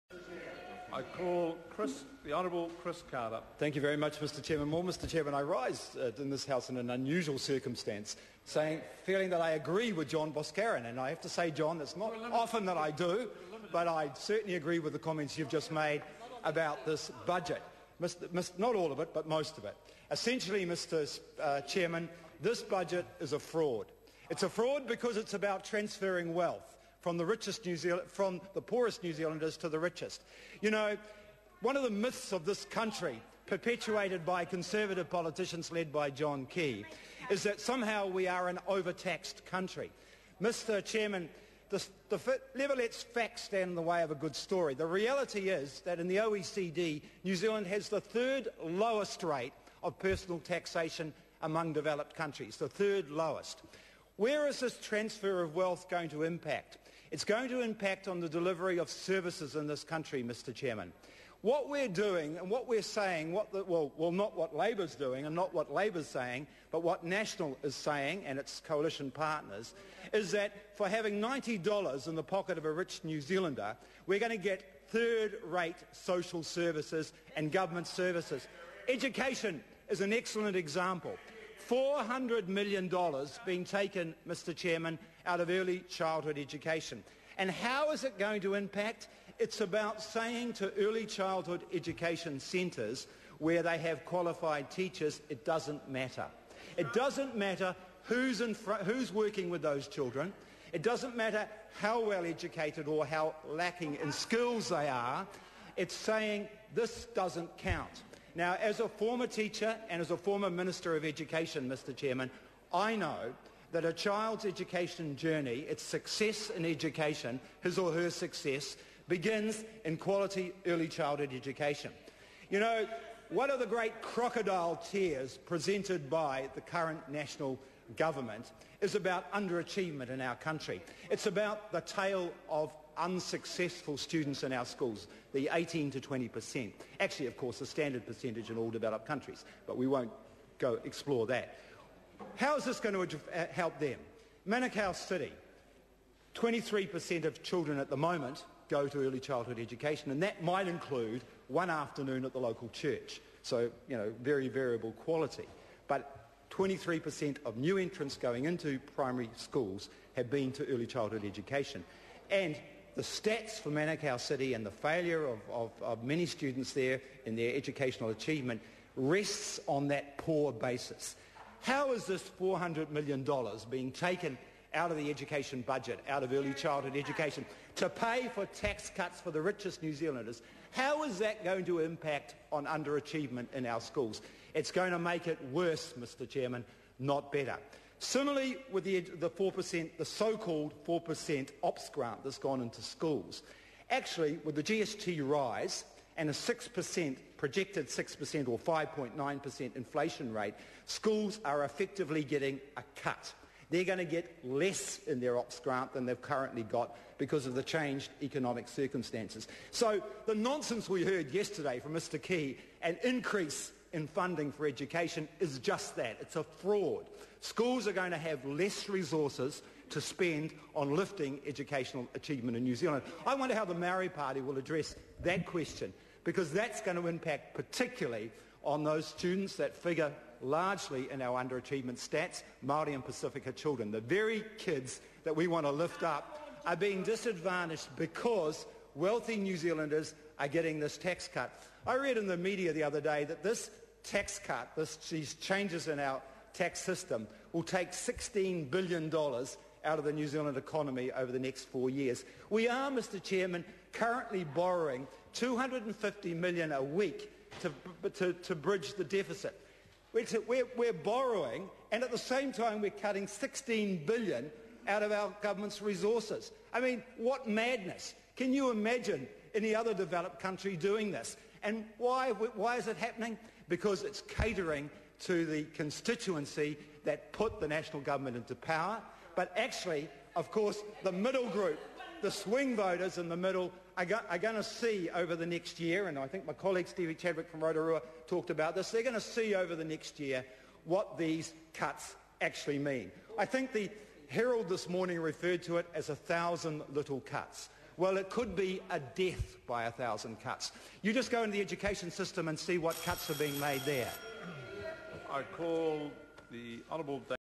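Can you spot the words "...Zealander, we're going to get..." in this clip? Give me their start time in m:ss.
1:13.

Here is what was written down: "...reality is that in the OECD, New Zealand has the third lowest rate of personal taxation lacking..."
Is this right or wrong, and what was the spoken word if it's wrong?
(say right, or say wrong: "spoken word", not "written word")
wrong: "among", not "lacking".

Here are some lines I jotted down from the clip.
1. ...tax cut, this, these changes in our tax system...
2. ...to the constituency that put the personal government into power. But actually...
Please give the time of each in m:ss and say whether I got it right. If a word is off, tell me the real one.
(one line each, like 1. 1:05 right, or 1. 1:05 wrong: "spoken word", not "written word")
1. 4:04 right
2. 4:35 wrong: "national", not "personal".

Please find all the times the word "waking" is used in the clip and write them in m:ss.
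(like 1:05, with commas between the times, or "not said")
not said.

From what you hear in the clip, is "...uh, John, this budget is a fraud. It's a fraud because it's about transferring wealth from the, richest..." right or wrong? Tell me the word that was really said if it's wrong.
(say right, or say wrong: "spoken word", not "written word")
wrong: "Chairman", not "John".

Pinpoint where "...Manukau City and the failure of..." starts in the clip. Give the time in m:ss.
2:43.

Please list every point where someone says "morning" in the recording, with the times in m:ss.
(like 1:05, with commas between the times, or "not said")
4:54.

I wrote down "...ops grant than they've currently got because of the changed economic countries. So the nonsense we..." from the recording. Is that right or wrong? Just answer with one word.
wrong.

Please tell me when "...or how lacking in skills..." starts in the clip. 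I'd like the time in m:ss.
1:42.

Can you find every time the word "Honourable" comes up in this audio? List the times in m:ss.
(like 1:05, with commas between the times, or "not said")
0:02, 5:06.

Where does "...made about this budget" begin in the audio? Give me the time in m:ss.
0:15.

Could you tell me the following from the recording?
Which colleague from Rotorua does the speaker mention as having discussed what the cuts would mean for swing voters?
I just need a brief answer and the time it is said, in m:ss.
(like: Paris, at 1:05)
Stevie Chadwick, at 4:46.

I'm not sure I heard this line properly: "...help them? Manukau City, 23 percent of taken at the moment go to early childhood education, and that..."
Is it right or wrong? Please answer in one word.
wrong.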